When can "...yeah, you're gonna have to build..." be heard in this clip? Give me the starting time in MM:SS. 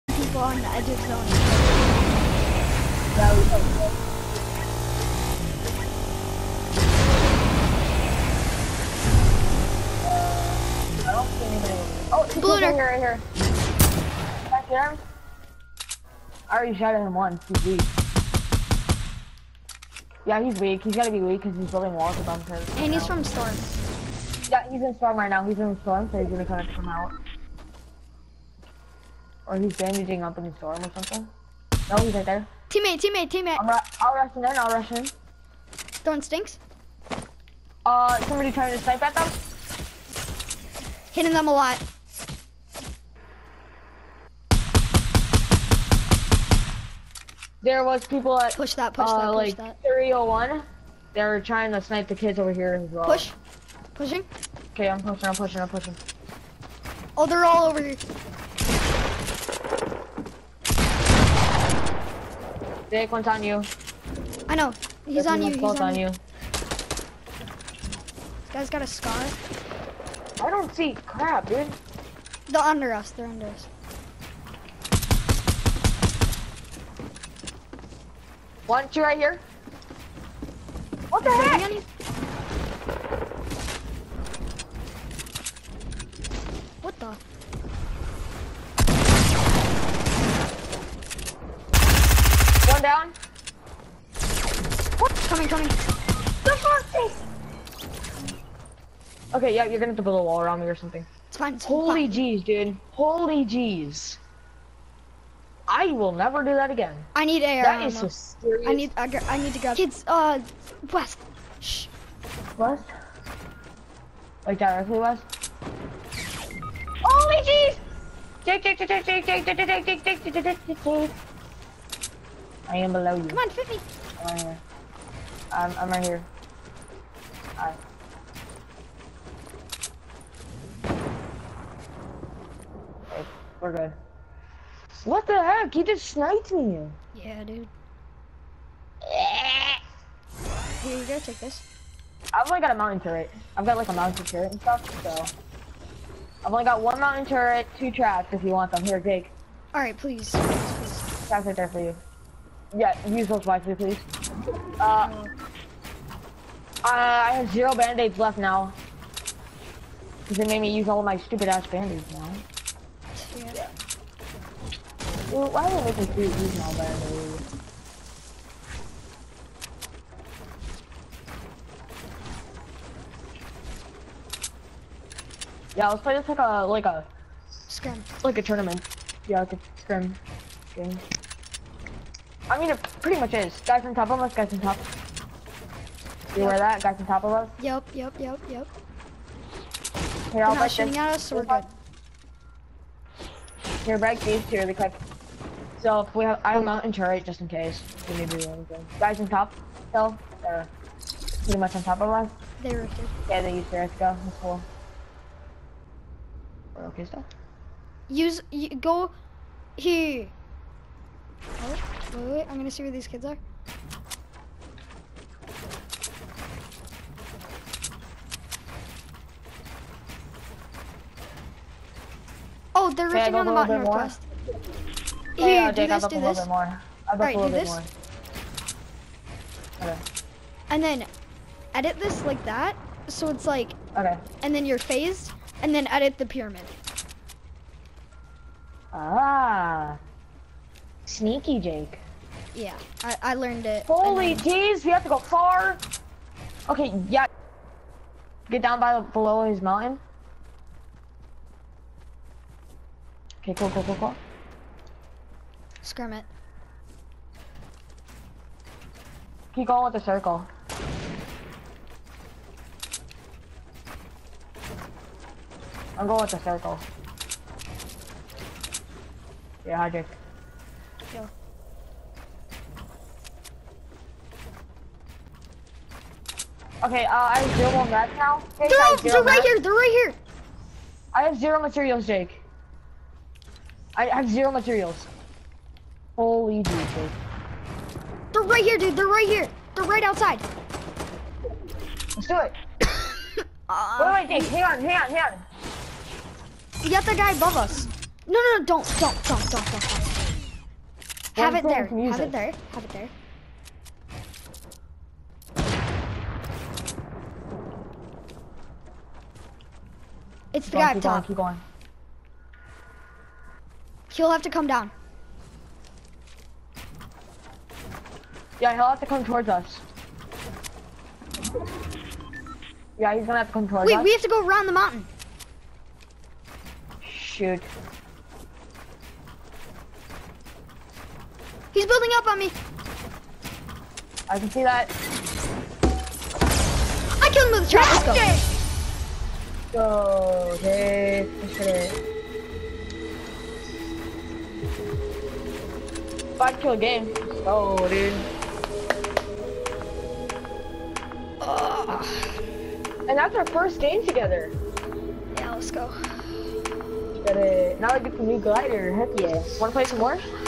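01:39.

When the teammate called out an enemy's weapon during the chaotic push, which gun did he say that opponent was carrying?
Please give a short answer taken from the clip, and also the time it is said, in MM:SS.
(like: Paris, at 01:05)
Scar, at 01:06.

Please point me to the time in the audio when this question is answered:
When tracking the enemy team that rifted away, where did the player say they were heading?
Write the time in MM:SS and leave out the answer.
03:43.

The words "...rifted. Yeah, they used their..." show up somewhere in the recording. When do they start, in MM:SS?
03:22.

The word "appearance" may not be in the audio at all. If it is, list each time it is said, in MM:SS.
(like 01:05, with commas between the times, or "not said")
not said.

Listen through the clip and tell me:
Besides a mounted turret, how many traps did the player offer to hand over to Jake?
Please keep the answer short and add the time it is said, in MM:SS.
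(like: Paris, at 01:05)
2, at 02:27.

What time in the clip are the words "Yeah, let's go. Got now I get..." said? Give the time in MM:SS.
05:55.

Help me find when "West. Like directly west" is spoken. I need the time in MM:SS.
01:52.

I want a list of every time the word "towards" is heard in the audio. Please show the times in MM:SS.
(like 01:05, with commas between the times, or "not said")
05:19, 05:23.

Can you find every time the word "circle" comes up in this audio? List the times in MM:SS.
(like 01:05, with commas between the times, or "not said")
04:20, 04:26.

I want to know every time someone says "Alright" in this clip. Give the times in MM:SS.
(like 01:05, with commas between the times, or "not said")
02:07, 02:29.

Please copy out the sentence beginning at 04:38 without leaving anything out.
Okay, they're, they're right here, they're right here!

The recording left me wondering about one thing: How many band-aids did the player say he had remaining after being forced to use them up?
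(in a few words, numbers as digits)
0.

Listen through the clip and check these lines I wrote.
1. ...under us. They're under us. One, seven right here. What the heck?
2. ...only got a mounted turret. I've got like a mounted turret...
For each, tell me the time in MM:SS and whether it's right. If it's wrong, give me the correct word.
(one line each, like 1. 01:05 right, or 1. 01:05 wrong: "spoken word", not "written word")
1. 01:12 wrong: "two", not "seven"
2. 02:22 right.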